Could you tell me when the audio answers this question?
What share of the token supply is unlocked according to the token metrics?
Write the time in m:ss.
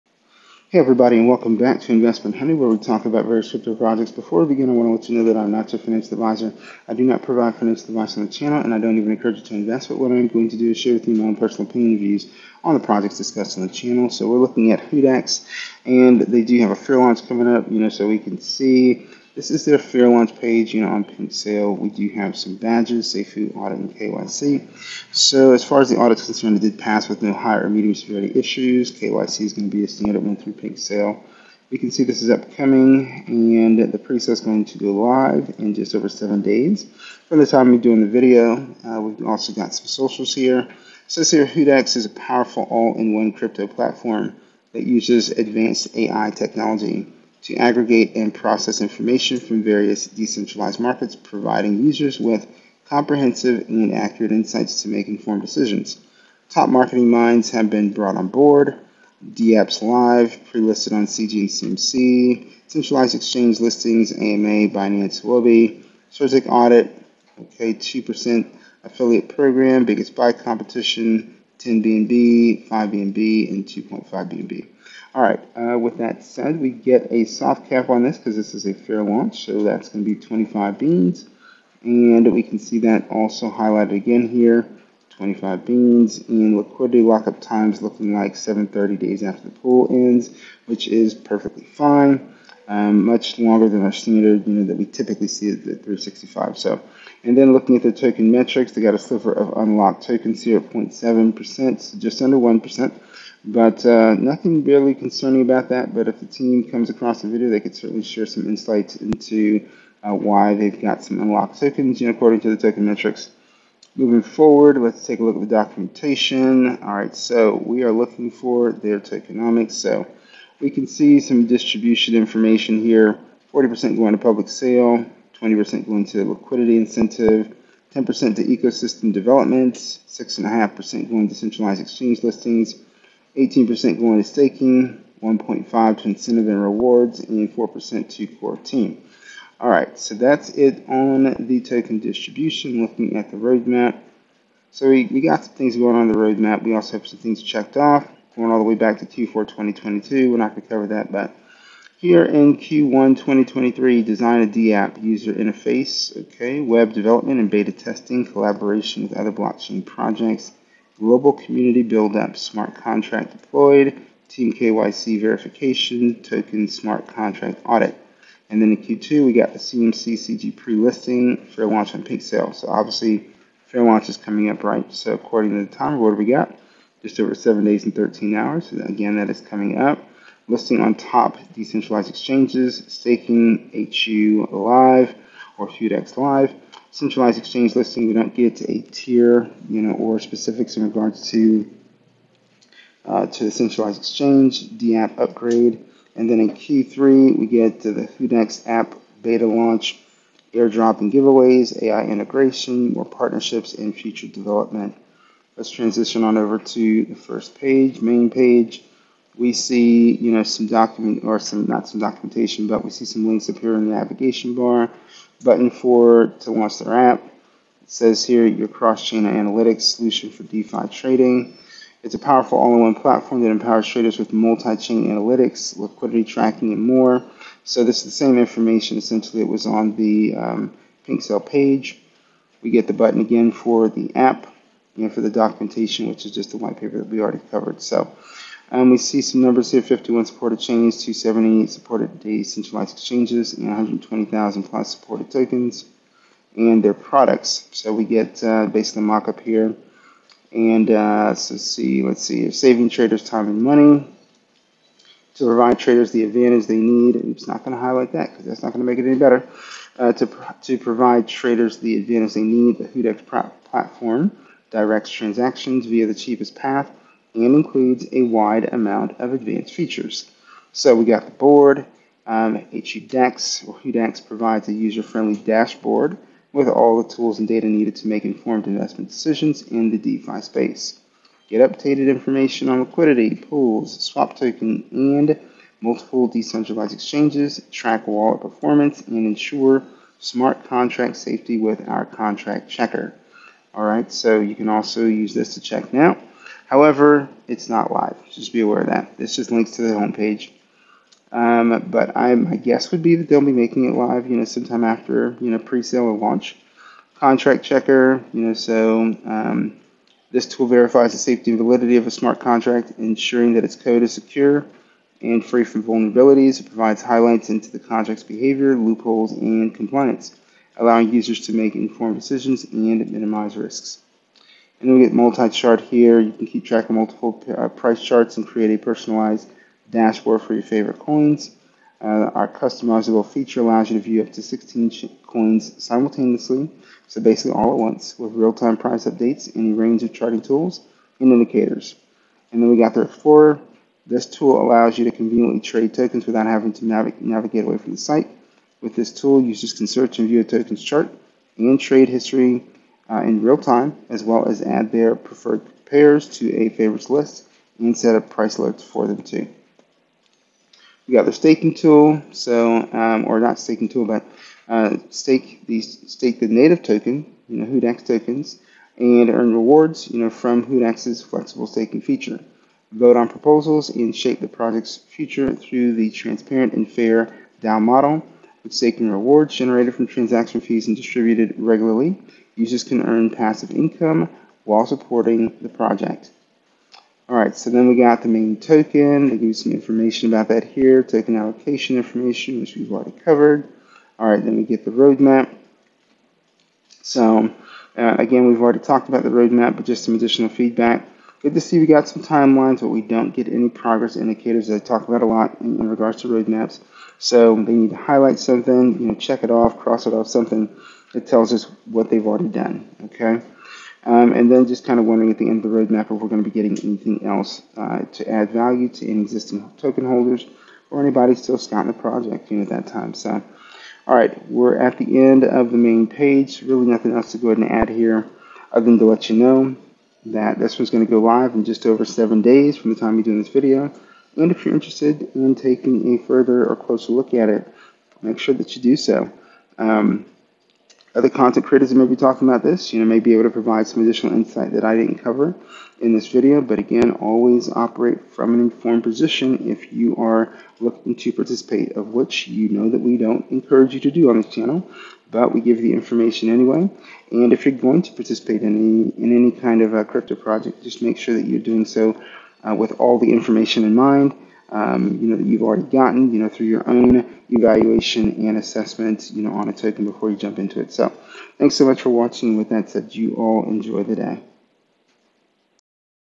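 1:40.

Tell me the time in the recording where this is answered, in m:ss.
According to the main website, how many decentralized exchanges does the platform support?
4:01.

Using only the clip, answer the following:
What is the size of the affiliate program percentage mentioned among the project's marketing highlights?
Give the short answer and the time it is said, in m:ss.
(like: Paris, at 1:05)
2%, at 1:07.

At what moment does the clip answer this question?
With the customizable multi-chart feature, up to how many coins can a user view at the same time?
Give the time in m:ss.
5:34.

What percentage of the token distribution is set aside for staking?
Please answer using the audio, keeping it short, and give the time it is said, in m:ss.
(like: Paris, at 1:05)
18%, at 2:13.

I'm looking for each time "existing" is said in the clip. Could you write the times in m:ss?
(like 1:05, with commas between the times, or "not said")
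6:59.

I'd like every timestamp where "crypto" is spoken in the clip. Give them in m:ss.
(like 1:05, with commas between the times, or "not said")
0:03, 0:43, 7:40.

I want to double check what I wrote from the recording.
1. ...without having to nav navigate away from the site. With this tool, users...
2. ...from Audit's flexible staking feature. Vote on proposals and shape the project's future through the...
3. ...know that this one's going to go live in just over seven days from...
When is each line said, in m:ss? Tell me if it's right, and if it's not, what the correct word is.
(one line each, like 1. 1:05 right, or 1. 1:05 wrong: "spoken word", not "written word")
1. 5:46 right
2. 6:10 wrong: "Hudex", not "Audit"
3. 7:09 right.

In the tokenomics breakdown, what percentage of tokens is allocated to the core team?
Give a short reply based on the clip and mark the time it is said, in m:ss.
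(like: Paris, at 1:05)
4%, at 2:17.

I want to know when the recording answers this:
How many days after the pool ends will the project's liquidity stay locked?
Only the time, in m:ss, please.
1:28.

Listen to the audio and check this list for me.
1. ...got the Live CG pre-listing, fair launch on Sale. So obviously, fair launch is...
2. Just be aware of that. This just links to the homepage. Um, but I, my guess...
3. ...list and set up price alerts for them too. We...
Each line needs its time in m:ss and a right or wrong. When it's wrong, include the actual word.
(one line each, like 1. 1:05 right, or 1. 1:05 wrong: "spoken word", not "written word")
1. 2:49 wrong: "CMC", not "Live"
2. 4:58 right
3. 5:57 right.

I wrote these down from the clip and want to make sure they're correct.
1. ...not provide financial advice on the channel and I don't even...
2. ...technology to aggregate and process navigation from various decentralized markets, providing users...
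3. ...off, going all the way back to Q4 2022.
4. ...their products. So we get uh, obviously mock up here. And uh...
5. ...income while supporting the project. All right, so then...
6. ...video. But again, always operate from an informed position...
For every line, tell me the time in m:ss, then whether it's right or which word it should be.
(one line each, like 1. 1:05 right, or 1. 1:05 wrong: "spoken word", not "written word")
1. 0:07 right
2. 0:46 wrong: "information", not "navigation"
3. 2:27 right
4. 4:06 wrong: "basically", not "obviously"
5. 6:23 right
6. 7:26 right.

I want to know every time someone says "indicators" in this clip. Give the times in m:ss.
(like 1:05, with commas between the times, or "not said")
5:41, 6:44.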